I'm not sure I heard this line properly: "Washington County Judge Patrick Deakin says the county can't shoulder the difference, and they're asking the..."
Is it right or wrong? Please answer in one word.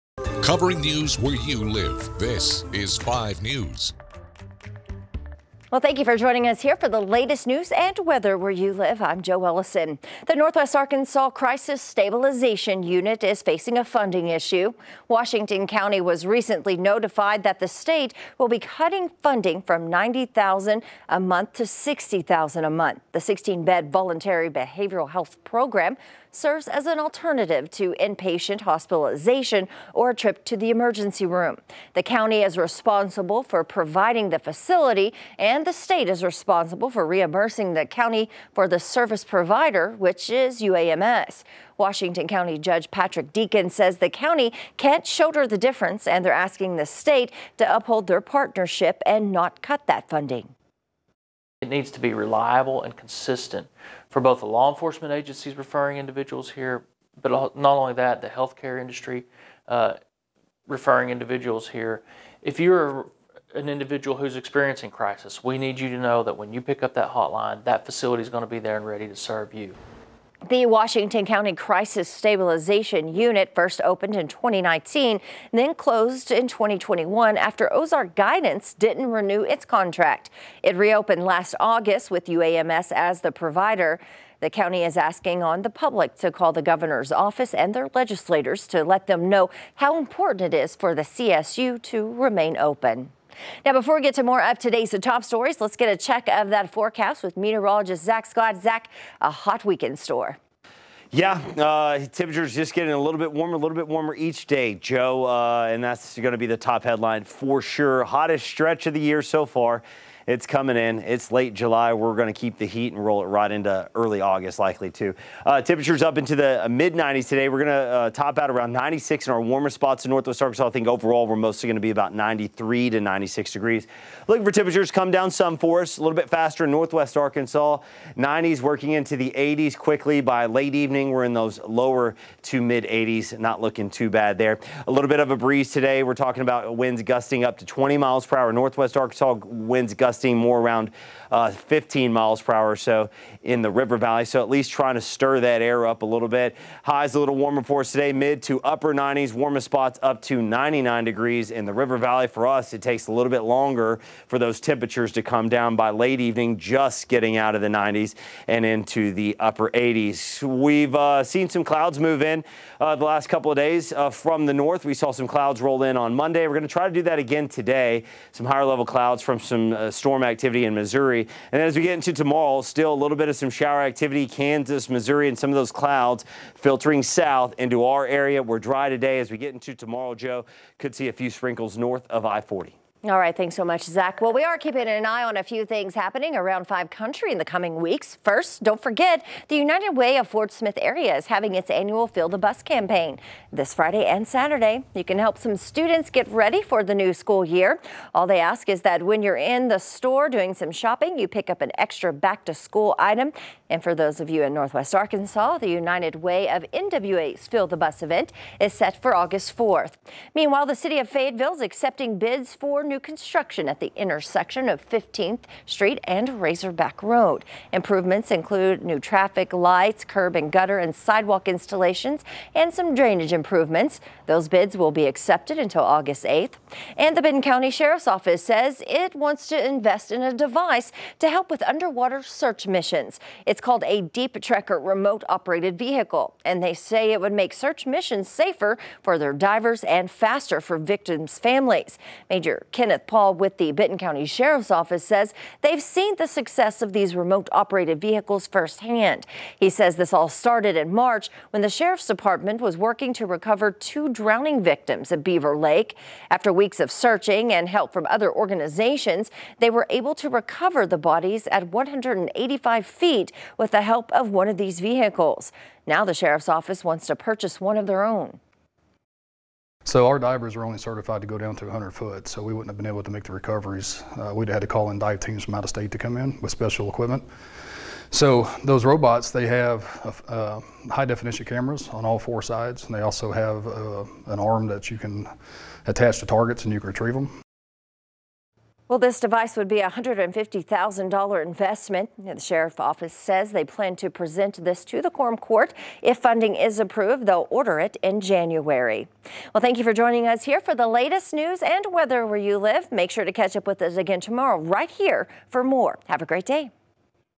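right.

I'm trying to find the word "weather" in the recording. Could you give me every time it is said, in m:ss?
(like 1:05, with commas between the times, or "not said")
0:07, 5:01.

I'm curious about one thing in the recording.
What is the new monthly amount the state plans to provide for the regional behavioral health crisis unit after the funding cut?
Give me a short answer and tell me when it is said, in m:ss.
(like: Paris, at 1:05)
$60,000, at 0:21.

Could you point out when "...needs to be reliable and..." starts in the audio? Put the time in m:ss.
0:51.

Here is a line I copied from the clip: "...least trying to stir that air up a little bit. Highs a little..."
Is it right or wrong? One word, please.
right.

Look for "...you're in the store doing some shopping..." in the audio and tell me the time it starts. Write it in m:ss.
3:19.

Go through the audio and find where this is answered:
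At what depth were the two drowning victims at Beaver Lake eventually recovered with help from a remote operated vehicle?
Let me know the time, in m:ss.
4:21.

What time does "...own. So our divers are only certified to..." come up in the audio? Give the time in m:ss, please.
4:28.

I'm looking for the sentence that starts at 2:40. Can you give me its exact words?
We've uh, seen some clouds move in uh, the last couple of days uh, from the north.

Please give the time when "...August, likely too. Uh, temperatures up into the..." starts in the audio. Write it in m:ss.
1:54.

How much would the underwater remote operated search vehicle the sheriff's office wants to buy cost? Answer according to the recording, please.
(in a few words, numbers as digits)
$150,000.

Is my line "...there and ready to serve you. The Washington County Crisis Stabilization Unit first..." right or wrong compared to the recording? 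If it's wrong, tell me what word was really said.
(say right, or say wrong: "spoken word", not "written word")
right.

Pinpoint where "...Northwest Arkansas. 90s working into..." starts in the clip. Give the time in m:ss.
2:06.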